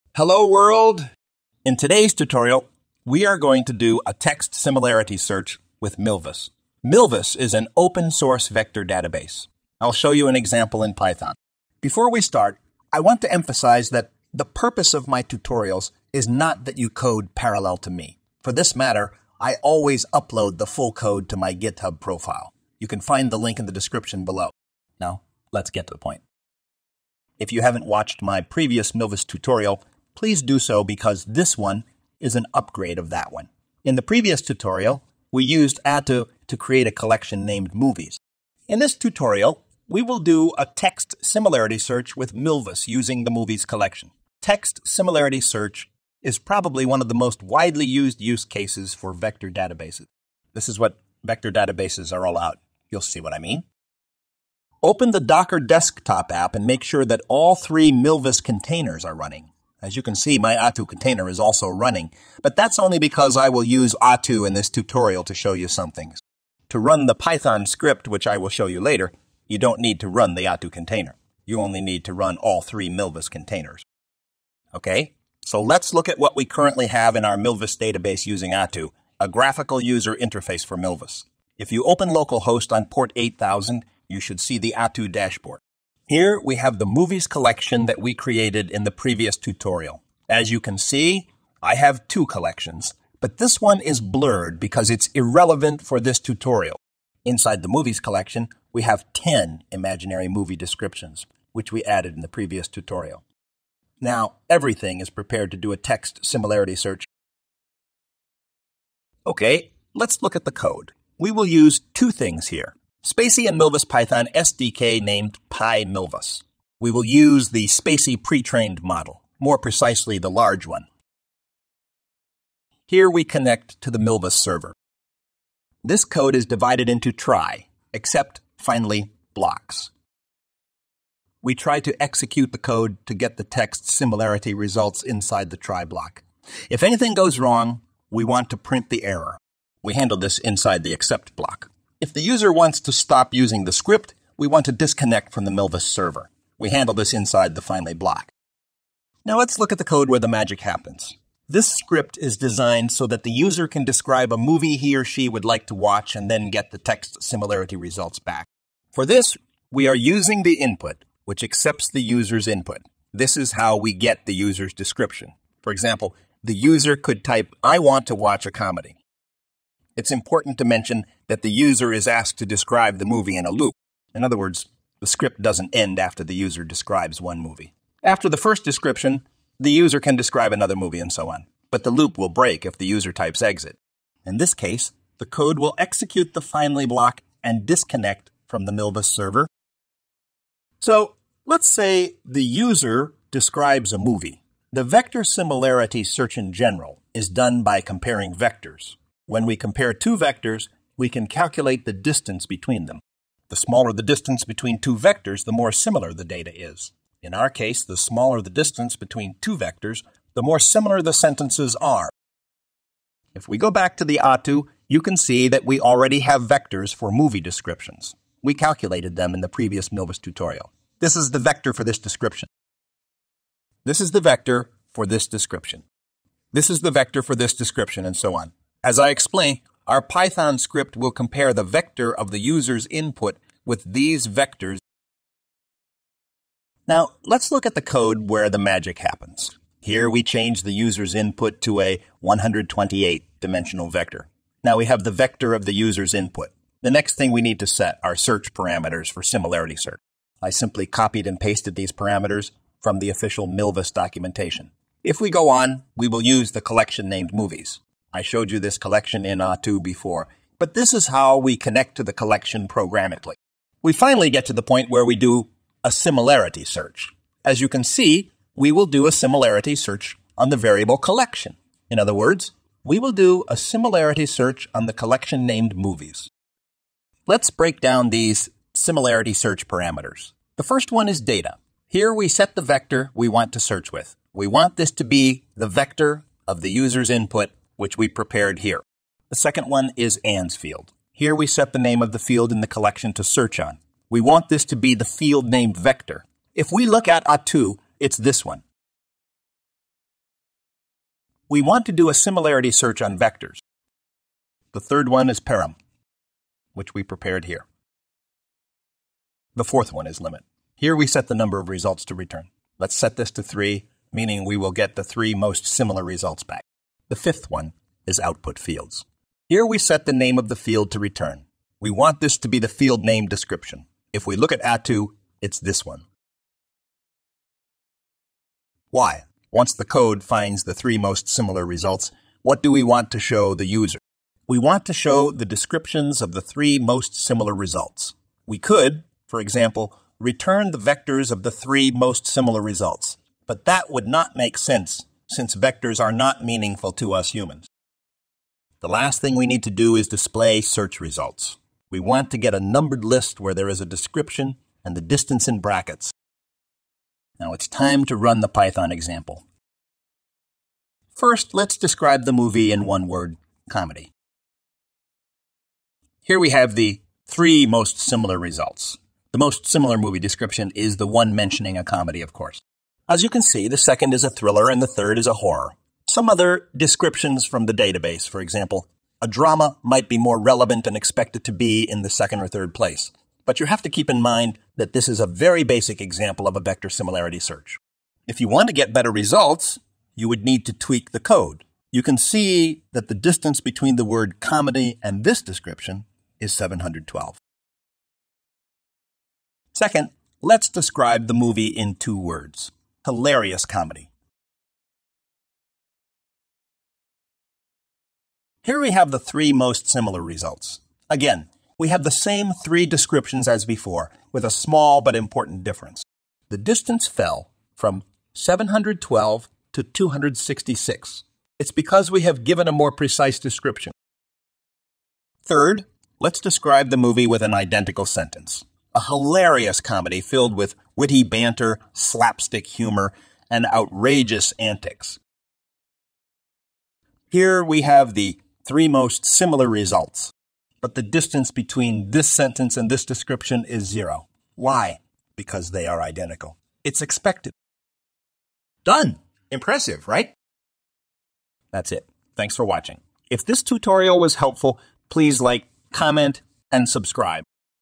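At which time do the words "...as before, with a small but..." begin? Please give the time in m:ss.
6:53.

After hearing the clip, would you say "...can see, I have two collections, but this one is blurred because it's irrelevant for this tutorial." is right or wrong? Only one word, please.
right.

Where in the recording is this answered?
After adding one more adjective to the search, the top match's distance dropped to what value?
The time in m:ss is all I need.
6:59.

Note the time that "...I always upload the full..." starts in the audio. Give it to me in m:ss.
0:19.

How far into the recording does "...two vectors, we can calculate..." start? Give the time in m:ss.
3:19.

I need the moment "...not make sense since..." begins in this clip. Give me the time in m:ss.
5:44.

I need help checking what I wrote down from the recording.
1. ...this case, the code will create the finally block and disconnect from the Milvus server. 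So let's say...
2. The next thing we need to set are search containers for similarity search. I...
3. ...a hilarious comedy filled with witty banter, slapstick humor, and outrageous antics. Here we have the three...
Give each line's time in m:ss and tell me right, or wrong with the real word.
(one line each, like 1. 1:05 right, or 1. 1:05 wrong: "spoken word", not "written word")
1. 3:04 wrong: "execute", not "create"
2. 4:06 wrong: "parameters", not "containers"
3. 7:08 right.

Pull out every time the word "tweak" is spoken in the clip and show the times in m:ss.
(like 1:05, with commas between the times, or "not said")
6:30.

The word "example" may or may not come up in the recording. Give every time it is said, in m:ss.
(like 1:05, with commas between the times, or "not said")
0:10, 2:45, 5:39, 5:58, 6:18, 6:25.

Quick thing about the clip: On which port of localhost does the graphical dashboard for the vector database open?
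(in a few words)
8000.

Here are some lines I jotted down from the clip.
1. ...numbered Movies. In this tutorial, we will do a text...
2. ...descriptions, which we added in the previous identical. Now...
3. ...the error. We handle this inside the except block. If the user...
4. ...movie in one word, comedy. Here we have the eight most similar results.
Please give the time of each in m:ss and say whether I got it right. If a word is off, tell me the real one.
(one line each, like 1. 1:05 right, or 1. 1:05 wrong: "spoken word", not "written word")
1. 0:37 wrong: "named", not "numbered"
2. 1:40 wrong: "tutorial", not "identical"
3. 2:18 right
4. 6:02 wrong: "three", not "eight".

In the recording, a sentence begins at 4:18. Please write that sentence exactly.
I showed you this collection in two before, but this is how we connect to the collection programmatically.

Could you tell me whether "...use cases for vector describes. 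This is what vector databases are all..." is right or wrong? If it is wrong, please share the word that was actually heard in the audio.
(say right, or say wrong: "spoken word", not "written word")
wrong: "databases", not "describes".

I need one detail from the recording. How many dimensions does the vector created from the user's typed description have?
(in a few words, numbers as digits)
128.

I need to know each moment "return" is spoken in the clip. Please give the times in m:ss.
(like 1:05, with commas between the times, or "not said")
5:12, 5:20, 5:40.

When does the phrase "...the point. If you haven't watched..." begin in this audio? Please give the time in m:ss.
0:25.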